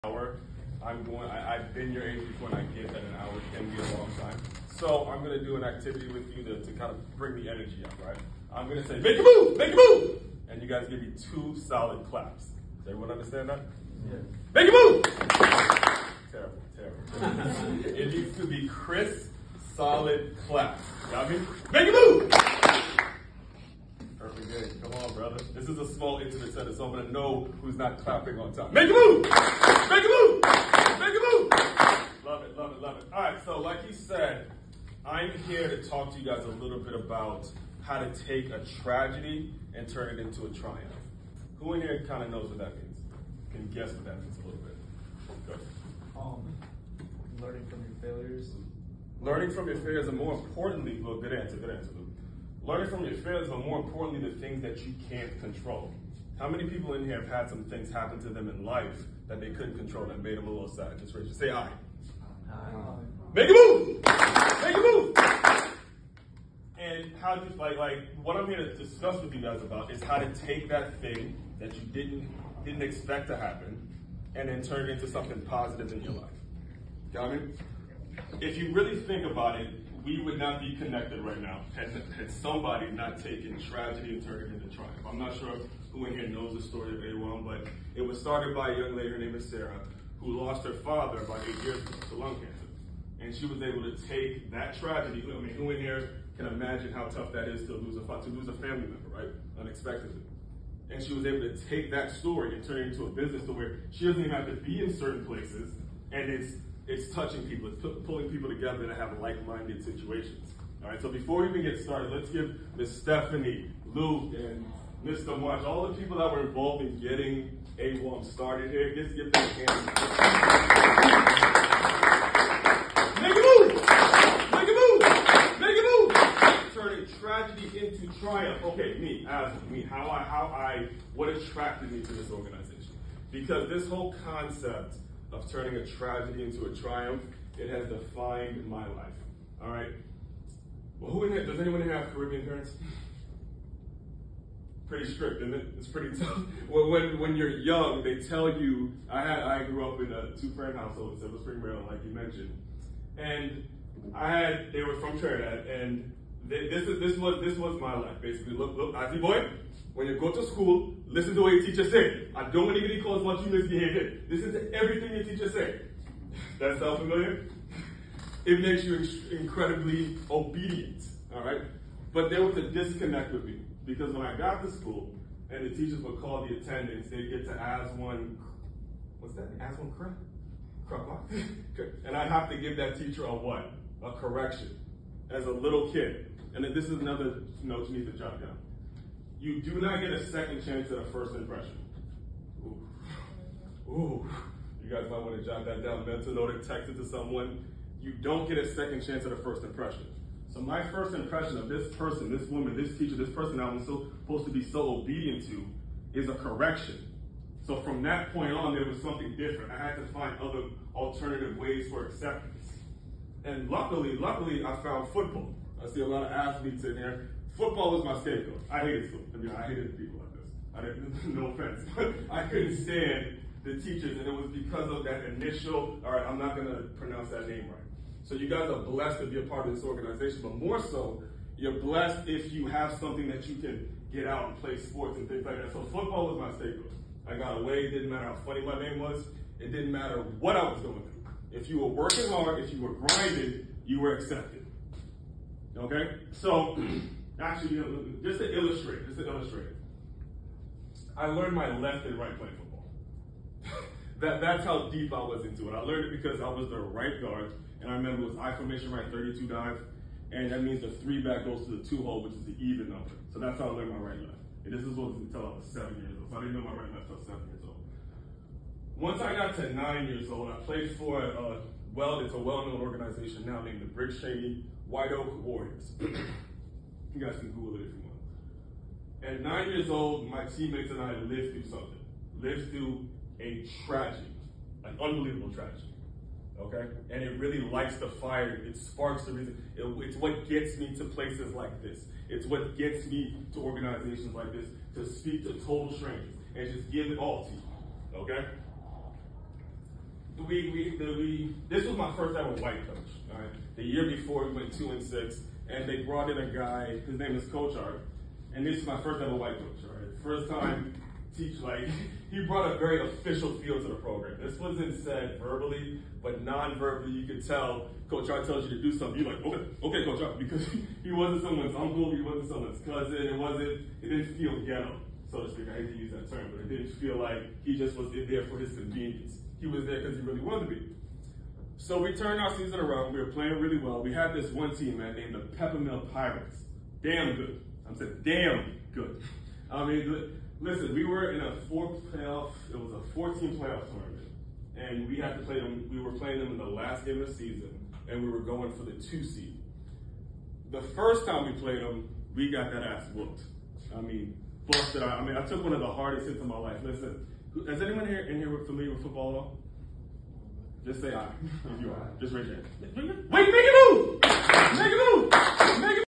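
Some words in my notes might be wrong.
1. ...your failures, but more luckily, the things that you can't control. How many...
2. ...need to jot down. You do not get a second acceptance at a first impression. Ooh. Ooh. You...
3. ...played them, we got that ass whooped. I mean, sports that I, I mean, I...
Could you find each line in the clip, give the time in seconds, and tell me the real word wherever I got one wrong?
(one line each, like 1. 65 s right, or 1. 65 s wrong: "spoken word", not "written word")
1. 53 s wrong: "importantly", not "luckily"
2. 187 s wrong: "chance", not "acceptance"
3. 351 s right.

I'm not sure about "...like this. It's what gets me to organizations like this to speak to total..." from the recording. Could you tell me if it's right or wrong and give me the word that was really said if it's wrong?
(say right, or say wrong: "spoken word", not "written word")
right.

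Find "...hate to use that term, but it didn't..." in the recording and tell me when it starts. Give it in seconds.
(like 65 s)
325 s.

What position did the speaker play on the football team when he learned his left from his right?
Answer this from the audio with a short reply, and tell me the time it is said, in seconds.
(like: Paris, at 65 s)
right guard, at 256 s.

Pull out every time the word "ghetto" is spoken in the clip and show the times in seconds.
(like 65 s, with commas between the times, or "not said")
324 s.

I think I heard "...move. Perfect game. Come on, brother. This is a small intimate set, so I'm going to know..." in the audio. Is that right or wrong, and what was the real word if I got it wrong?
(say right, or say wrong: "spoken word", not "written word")
right.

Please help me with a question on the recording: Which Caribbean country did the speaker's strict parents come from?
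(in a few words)
Trinidad.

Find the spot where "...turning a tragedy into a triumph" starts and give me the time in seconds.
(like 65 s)
135 s.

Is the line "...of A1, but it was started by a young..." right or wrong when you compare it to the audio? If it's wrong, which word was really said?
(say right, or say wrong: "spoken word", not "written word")
right.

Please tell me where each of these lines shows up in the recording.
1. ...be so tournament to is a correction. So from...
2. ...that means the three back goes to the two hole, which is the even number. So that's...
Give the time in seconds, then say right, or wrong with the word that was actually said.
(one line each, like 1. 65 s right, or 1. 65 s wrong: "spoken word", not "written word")
1. 204 s wrong: "obedient", not "tournament"
2. 260 s right.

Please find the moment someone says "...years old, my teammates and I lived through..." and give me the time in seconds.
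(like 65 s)
279 s.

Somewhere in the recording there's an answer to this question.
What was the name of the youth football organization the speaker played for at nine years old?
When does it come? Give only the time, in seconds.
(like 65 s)
273 s.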